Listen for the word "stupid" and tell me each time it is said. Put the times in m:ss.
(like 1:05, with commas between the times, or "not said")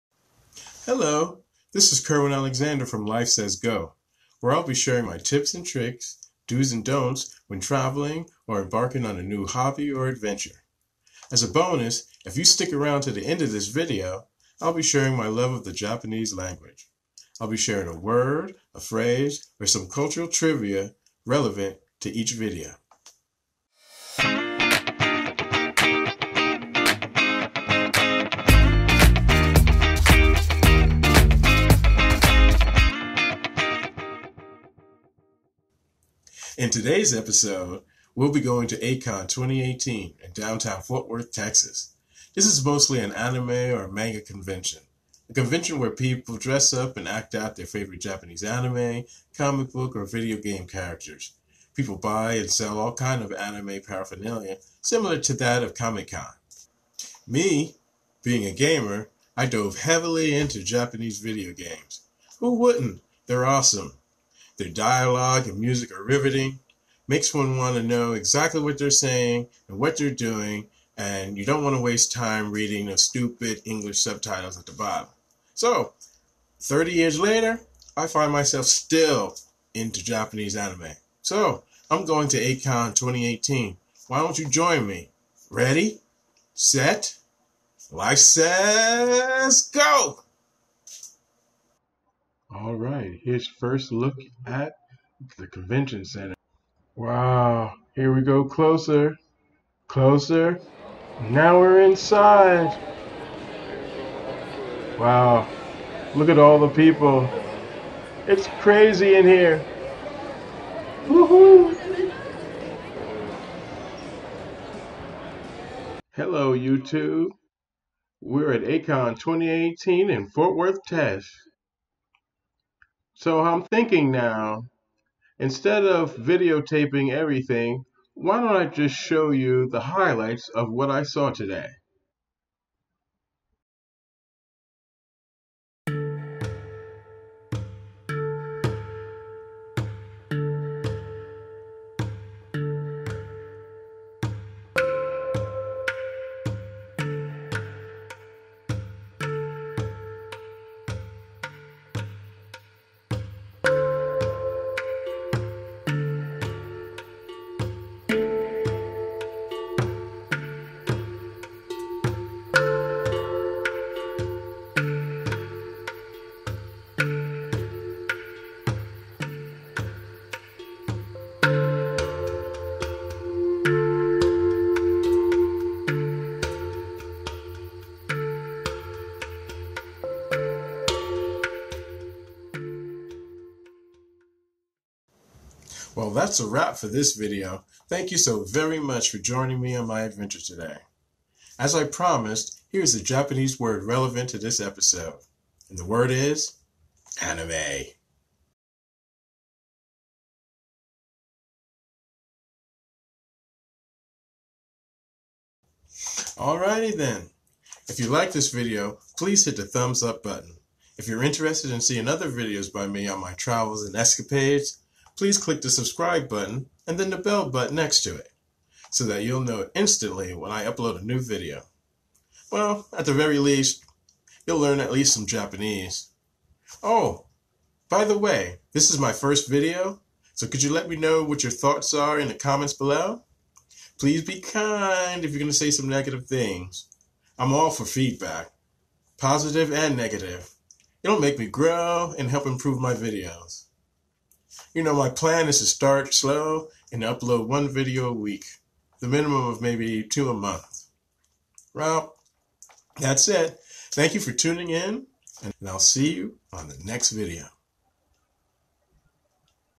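1:12.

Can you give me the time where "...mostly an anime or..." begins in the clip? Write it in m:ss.
0:42.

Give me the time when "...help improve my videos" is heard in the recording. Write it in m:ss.
4:02.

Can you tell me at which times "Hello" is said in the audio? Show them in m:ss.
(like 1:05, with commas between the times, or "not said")
0:00, 1:56.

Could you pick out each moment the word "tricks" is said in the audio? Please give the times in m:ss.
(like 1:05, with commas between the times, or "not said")
0:05.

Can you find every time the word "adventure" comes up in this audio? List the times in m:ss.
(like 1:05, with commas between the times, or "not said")
0:10, 3:10.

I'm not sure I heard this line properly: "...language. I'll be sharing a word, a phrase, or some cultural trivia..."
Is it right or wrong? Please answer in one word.
right.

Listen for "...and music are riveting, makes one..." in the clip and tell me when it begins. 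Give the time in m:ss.
1:05.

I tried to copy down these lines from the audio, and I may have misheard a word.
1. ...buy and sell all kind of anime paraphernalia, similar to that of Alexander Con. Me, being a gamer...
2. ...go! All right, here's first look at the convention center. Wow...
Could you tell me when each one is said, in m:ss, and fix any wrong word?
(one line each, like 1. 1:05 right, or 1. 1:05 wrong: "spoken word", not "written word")
1. 0:51 wrong: "Comic", not "Alexander"
2. 1:29 right.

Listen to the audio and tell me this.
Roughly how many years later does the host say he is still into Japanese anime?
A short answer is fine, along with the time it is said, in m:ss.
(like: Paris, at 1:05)
30, at 1:16.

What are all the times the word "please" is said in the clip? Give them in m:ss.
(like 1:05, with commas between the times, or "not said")
3:29, 3:35, 3:53.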